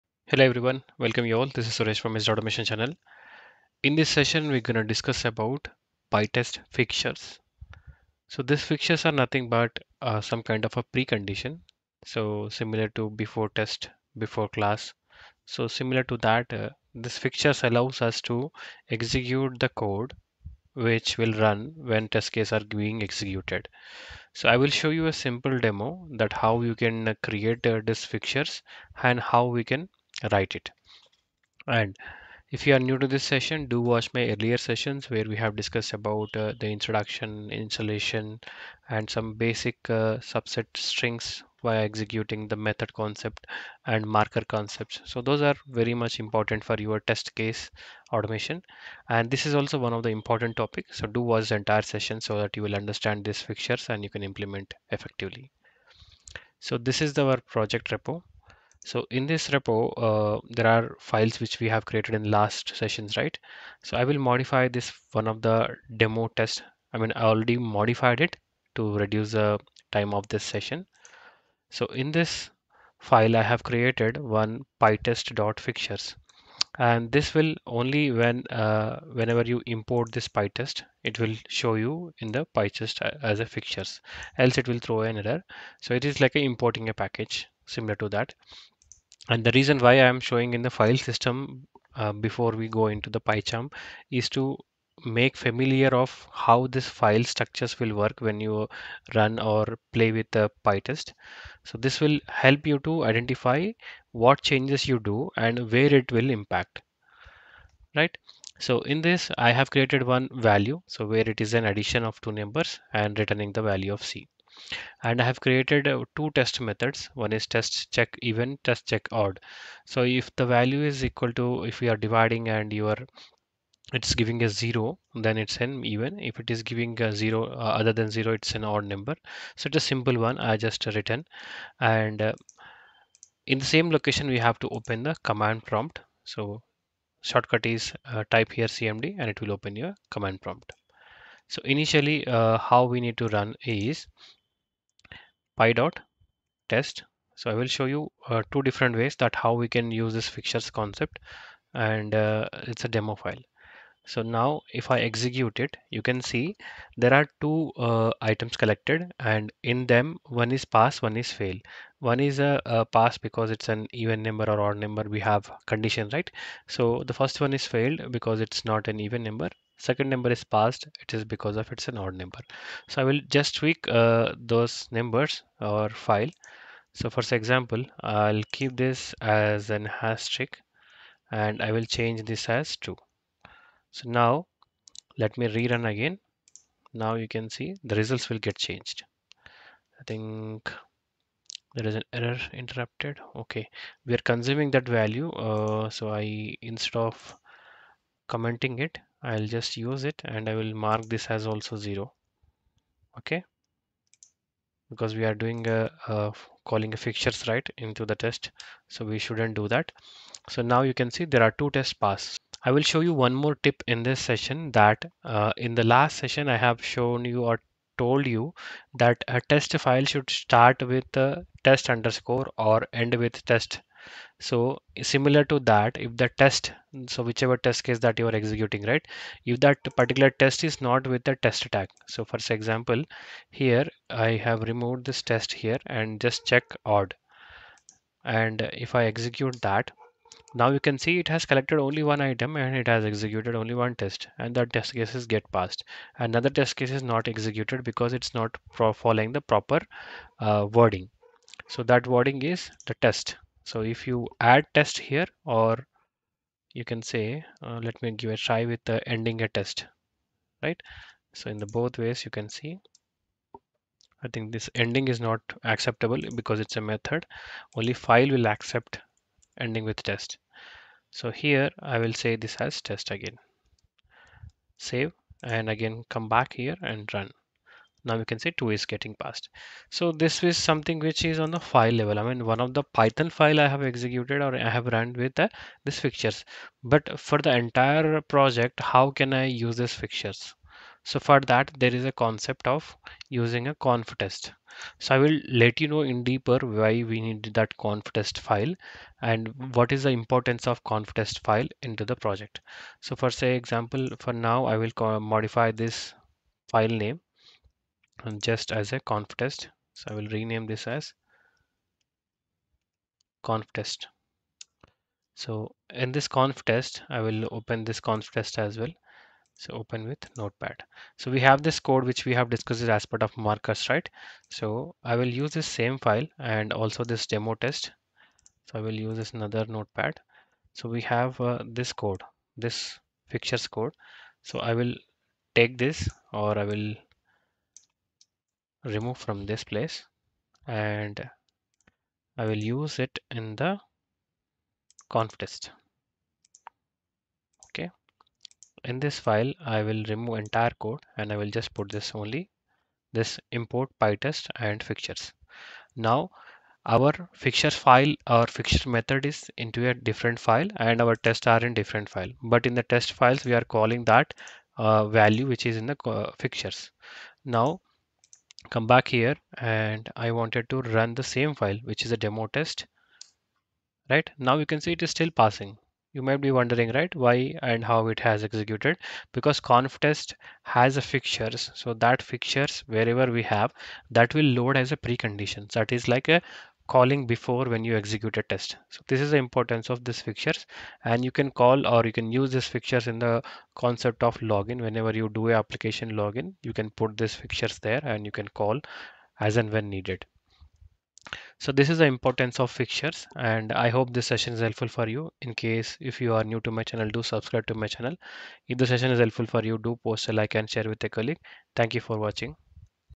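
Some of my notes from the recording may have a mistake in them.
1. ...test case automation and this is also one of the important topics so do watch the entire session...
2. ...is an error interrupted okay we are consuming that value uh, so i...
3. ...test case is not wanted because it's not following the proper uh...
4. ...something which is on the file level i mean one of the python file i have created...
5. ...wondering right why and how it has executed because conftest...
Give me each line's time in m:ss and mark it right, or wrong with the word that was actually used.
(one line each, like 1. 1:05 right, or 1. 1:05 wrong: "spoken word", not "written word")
1. 0:46 right
2. 3:11 right
3. 4:06 wrong: "executed", not "wanted"
4. 4:40 wrong: "executed", not "created"
5. 6:16 right.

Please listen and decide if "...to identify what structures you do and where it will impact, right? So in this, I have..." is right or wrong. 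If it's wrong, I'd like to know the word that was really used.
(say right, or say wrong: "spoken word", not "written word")
wrong: "changes", not "structures".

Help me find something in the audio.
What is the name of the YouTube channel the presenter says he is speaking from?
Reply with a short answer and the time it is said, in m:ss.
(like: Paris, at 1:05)
Mr. Automation, at 0:02.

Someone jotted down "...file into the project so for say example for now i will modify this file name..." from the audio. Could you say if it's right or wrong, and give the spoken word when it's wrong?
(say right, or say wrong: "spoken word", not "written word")
right.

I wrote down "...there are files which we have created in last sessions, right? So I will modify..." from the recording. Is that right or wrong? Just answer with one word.
right.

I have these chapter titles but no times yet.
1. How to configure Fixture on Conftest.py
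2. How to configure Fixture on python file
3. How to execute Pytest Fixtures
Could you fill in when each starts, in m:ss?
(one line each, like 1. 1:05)
1. 4:45
2. 1:00
3. 2:15.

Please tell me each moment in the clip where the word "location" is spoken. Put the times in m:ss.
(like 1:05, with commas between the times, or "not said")
2:13.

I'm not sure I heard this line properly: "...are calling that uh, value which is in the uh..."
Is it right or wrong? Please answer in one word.
right.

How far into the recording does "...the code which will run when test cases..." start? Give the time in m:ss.
0:19.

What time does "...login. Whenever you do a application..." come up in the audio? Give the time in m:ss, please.
6:34.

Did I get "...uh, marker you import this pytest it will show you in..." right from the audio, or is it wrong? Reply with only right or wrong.
wrong.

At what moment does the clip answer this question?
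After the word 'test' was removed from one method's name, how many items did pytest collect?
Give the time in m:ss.
4:02.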